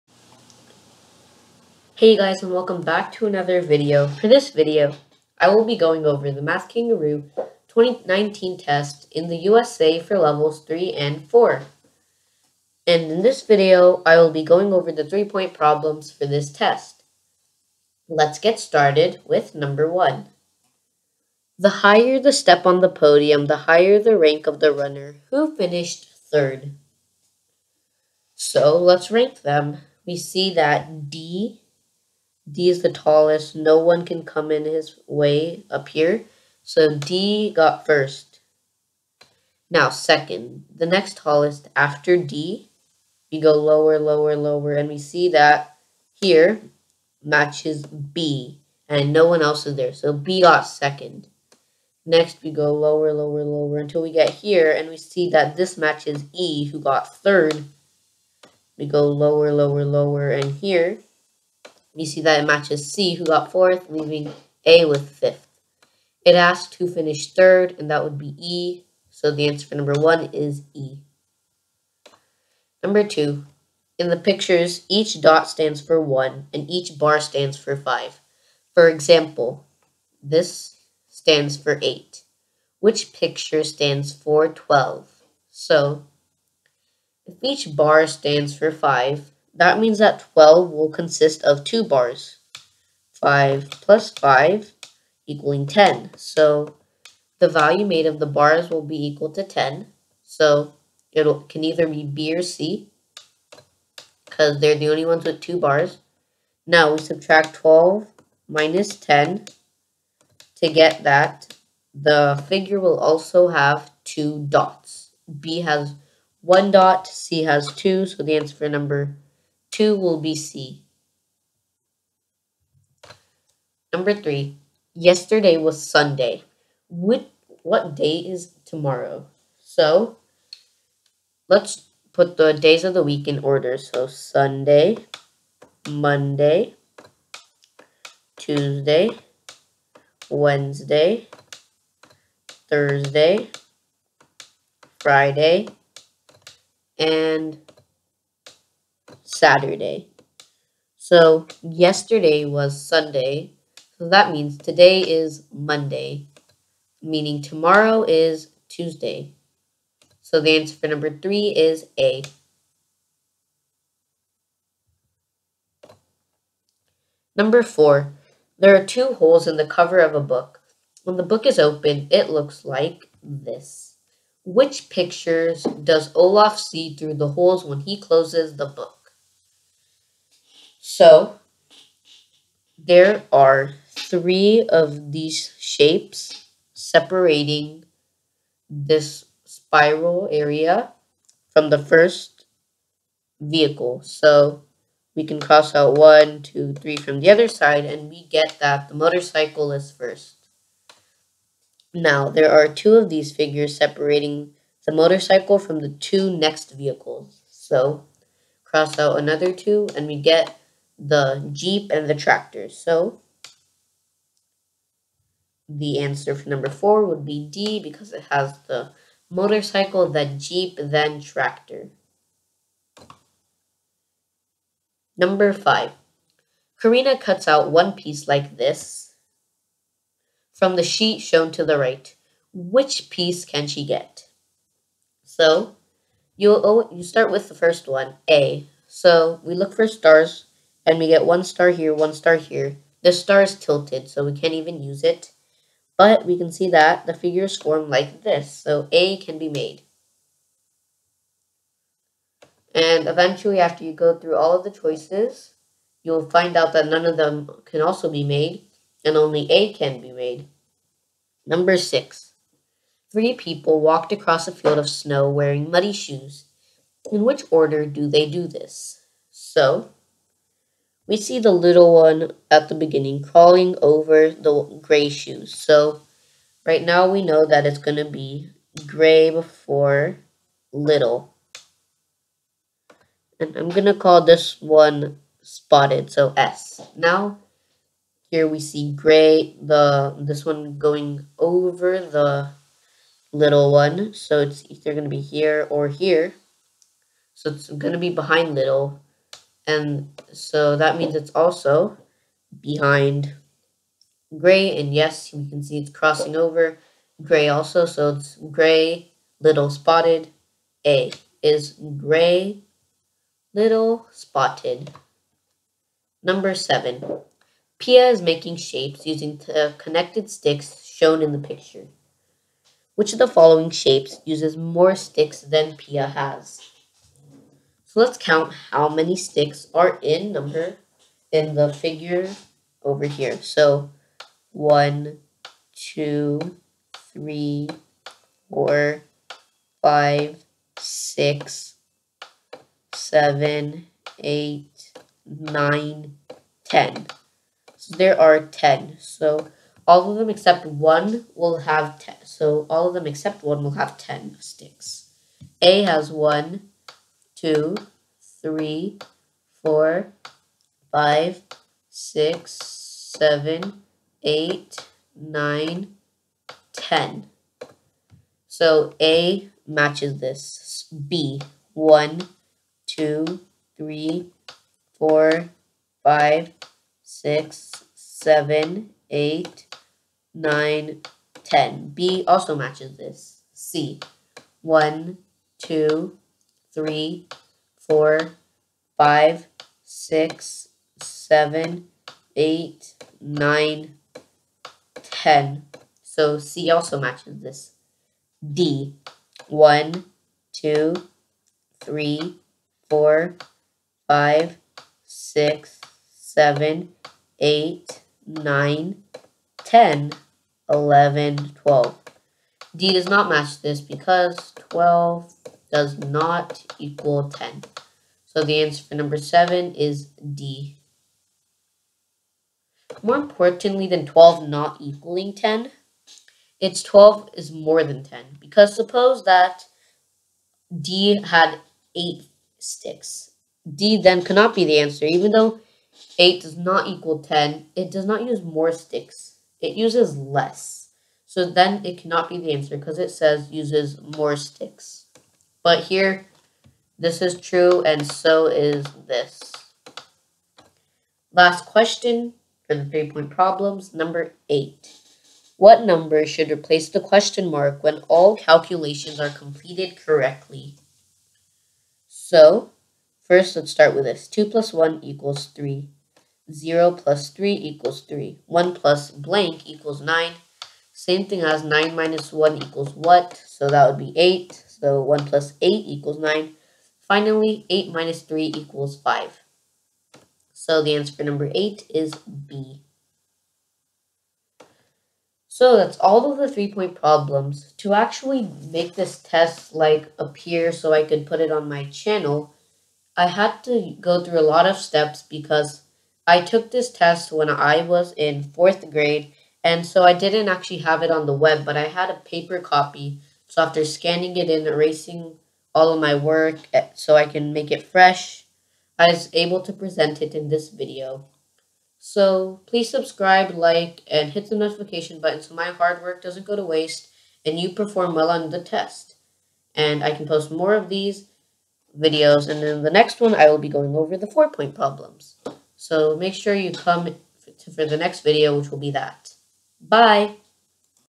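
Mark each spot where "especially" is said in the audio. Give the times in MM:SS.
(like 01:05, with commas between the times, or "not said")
not said.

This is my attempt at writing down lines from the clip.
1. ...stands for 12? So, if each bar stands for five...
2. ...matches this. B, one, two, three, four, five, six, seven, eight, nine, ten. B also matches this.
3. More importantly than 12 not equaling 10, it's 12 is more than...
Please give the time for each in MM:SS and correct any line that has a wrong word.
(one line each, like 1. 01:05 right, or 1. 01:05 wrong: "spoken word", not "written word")
1. 01:23 right
2. 06:09 right
3. 07:03 right.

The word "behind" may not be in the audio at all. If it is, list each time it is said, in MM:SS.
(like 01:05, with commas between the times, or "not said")
04:58, 05:02.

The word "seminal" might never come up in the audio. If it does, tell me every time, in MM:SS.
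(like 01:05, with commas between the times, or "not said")
not said.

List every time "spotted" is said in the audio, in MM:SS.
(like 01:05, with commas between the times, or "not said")
04:45, 05:09, 05:14.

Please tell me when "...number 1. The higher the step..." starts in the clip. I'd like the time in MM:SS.
00:19.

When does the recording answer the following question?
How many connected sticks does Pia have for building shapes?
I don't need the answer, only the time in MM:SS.
05:47.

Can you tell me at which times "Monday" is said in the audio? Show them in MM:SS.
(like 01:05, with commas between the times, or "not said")
02:15, 02:35.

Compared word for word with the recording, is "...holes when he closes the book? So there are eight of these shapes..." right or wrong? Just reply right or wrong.
wrong.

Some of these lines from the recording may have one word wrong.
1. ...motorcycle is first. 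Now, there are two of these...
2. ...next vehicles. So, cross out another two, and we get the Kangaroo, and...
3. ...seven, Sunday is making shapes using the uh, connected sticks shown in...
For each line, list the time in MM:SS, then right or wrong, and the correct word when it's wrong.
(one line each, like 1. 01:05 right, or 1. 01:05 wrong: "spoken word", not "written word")
1. 03:18 right
2. 03:26 wrong: "Jeep", not "Kangaroo"
3. 05:16 wrong: "Pia", not "Sunday".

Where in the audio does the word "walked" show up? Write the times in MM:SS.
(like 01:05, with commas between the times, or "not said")
04:23.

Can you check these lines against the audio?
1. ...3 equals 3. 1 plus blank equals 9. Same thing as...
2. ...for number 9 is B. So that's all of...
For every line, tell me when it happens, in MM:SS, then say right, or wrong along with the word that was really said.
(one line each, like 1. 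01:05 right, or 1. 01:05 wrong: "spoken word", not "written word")
1. 07:47 right
2. 08:01 wrong: "8", not "9".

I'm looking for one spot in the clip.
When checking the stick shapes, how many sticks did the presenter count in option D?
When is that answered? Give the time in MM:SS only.
06:51.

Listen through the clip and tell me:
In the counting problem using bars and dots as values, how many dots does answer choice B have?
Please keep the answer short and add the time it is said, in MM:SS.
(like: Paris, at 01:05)
1, at 01:55.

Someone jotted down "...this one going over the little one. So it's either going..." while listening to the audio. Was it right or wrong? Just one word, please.
right.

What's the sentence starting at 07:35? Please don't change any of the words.
What number should replace the question mark when all calculations are completed correctly?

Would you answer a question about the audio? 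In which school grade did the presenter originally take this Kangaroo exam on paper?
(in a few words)
Fourth grade.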